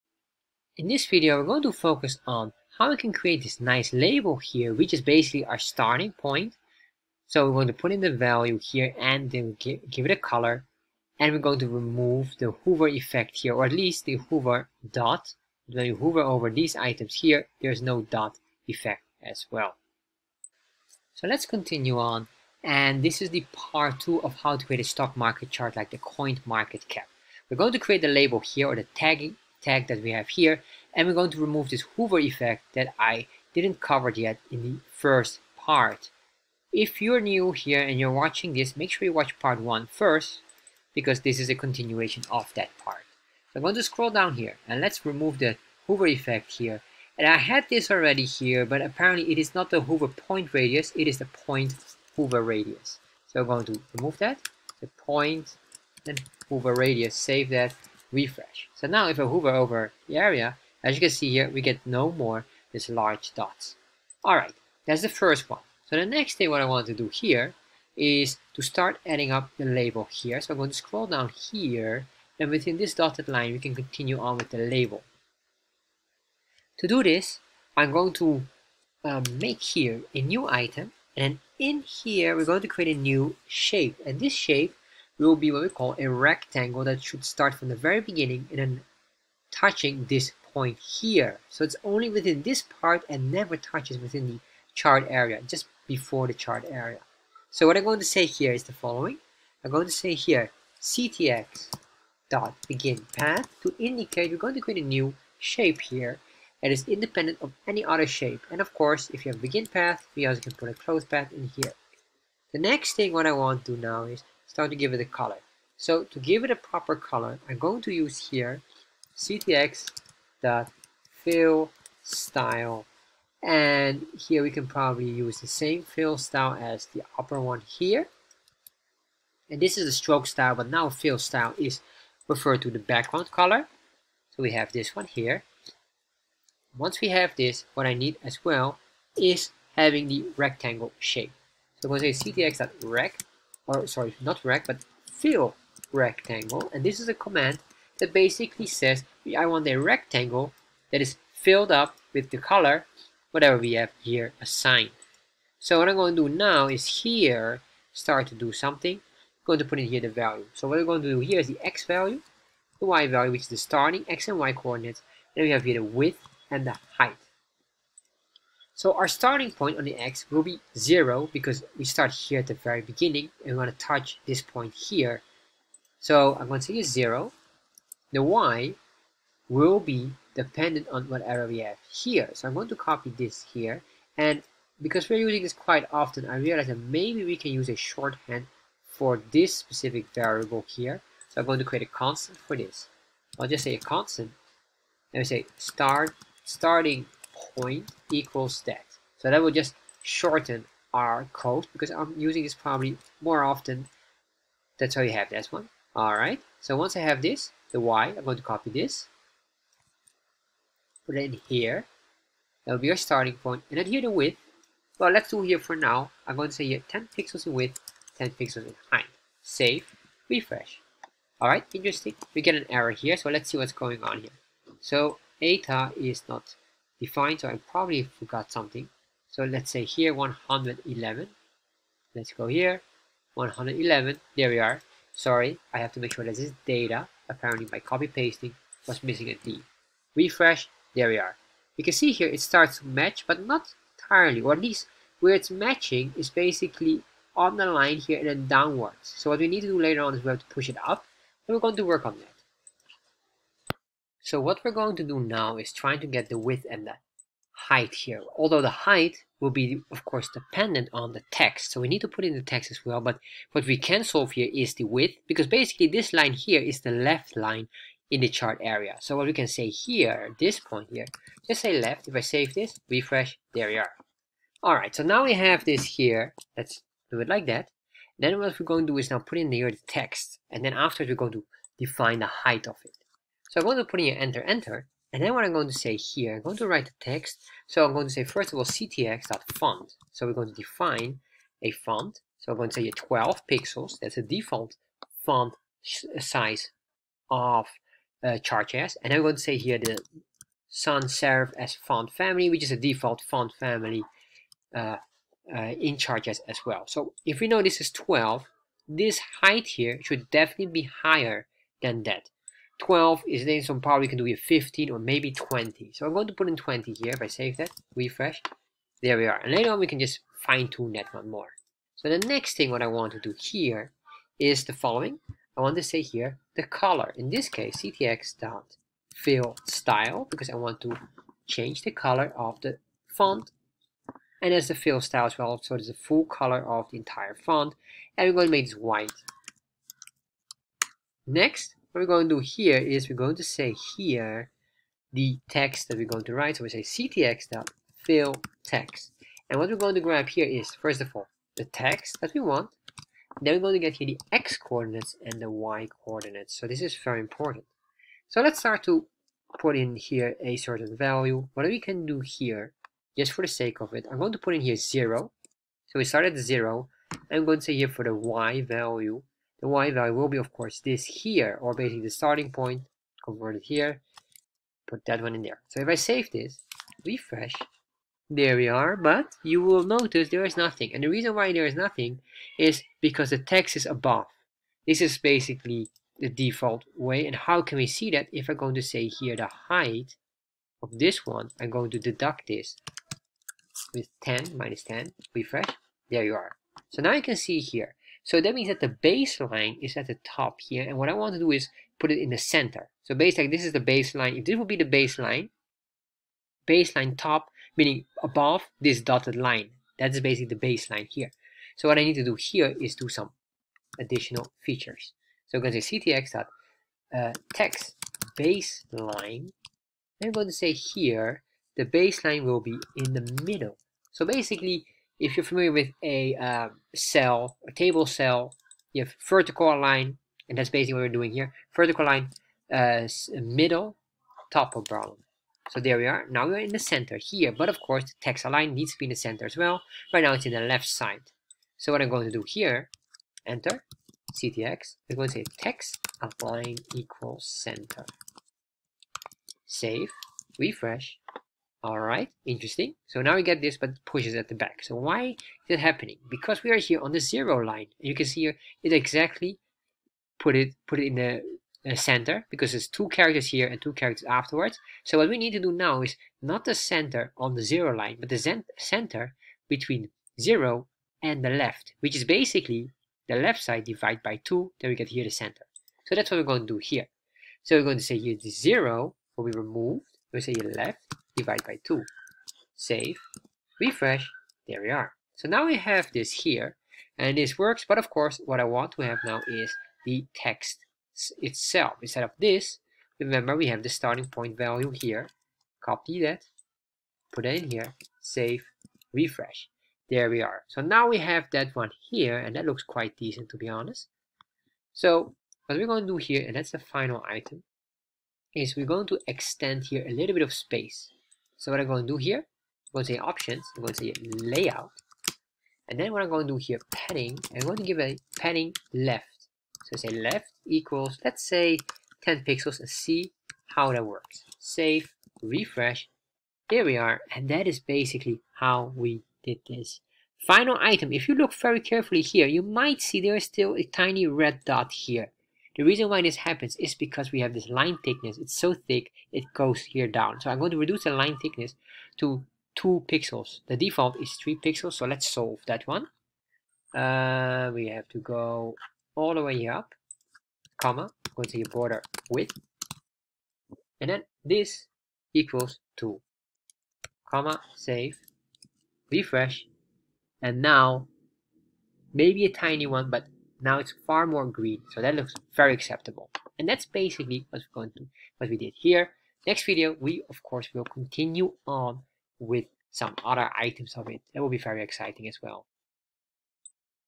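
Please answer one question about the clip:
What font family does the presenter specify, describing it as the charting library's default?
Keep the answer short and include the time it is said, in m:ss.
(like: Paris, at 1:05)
sans serif, at 5:00.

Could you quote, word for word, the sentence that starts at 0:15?
When you hover over these items here there's no dot effect as well.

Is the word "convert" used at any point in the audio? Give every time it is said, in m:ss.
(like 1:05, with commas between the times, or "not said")
6:13.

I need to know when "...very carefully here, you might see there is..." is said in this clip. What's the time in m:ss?
8:51.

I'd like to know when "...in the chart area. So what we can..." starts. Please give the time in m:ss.
4:28.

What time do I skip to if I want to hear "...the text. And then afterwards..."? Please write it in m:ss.
4:39.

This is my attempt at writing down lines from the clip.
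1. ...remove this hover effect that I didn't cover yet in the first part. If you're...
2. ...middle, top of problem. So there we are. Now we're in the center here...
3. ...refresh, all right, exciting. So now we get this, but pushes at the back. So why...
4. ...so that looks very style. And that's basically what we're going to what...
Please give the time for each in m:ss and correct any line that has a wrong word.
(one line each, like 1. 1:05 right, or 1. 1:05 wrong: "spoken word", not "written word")
1. 0:31 right
2. 7:13 right
3. 7:30 wrong: "interesting", not "exciting"
4. 9:24 wrong: "acceptable", not "style".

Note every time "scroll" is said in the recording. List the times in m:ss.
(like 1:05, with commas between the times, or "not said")
0:43, 1:10.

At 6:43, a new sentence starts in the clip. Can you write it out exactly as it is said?
So basically, this is the baseline.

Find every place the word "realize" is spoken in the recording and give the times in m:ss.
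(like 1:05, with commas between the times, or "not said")
3:06.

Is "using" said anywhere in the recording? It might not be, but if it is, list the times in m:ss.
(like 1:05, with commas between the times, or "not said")
3:05, 3:22.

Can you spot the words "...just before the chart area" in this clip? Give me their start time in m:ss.
1:35.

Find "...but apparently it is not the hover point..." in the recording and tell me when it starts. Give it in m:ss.
0:48.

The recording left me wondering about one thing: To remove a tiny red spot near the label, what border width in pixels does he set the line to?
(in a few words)
2.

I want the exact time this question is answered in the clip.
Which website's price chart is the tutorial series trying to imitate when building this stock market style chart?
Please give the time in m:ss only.
0:25.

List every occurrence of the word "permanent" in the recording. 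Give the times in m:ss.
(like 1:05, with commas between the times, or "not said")
not said.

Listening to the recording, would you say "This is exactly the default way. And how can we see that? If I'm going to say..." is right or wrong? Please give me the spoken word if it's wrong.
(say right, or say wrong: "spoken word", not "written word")
wrong: "basically", not "exactly".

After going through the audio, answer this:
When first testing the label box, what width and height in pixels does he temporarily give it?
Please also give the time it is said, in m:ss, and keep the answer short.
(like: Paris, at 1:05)
10 pixels, at 3:36.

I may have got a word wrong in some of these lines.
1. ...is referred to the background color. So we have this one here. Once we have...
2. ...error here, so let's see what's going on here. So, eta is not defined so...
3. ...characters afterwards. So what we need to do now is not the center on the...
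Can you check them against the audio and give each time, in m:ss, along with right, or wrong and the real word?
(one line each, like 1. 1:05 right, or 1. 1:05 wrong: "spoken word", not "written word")
1. 2:11 right
2. 3:42 right
3. 7:43 right.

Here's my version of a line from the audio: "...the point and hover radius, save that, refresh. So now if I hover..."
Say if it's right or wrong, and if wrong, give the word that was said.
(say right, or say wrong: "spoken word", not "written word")
right.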